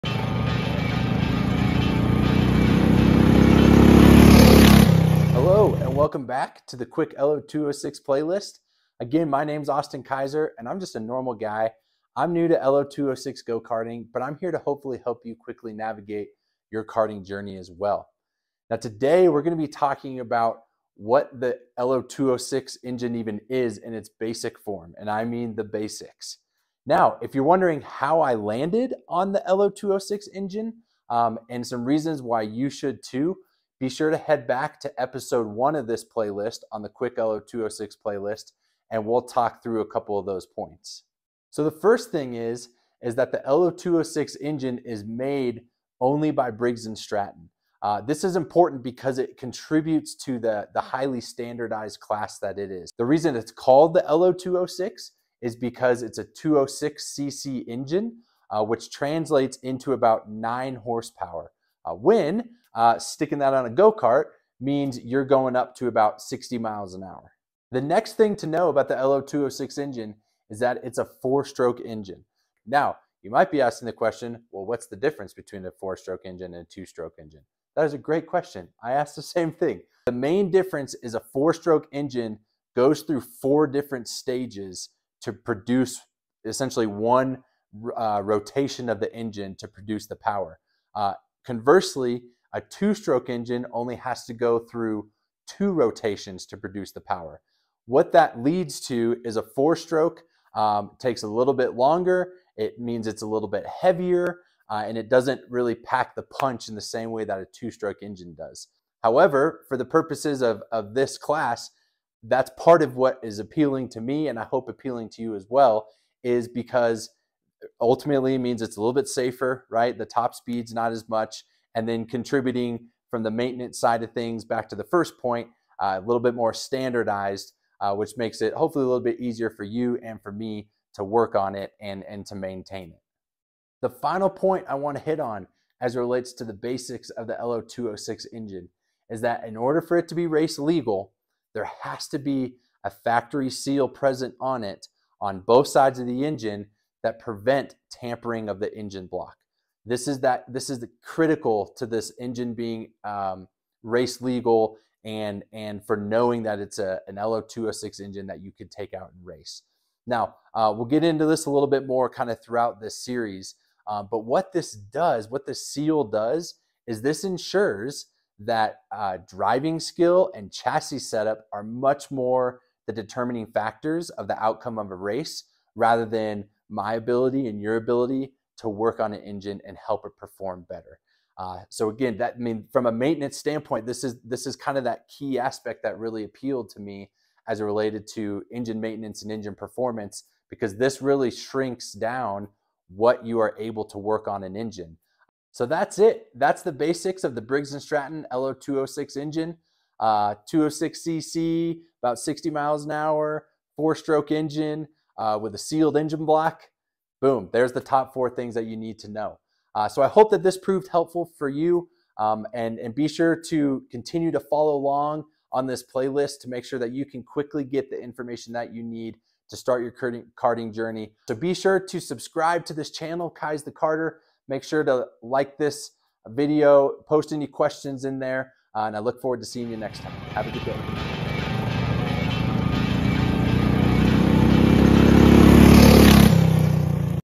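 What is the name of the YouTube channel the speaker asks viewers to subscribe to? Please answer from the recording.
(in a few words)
Kaiz the Karter.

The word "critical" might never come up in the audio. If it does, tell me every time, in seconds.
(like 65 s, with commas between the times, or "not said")
151 s.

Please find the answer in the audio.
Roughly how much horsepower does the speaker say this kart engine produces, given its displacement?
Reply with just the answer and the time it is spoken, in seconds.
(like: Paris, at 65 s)
9 horsepower, at 60 s.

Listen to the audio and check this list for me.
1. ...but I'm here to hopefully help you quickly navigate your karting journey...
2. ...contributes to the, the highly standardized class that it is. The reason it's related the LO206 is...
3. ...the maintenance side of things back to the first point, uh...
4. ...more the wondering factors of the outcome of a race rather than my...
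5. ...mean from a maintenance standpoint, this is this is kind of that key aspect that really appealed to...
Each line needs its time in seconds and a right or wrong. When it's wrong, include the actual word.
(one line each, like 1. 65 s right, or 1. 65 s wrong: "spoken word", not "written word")
1. 14 s right
2. 49 s wrong: "called", not "related"
3. 123 s right
4. 172 s wrong: "determining", not "wondering"
5. 182 s right.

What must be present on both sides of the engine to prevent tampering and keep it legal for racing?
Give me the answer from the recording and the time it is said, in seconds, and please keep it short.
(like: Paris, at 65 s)
factory seal, at 142 s.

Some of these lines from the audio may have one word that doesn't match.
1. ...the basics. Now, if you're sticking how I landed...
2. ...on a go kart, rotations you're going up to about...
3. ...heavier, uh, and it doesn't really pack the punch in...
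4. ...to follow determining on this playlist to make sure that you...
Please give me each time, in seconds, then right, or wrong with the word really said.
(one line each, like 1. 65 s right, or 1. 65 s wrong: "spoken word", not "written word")
1. 25 s wrong: "wondering", not "sticking"
2. 63 s wrong: "means", not "rotations"
3. 103 s right
4. 214 s wrong: "along", not "determining".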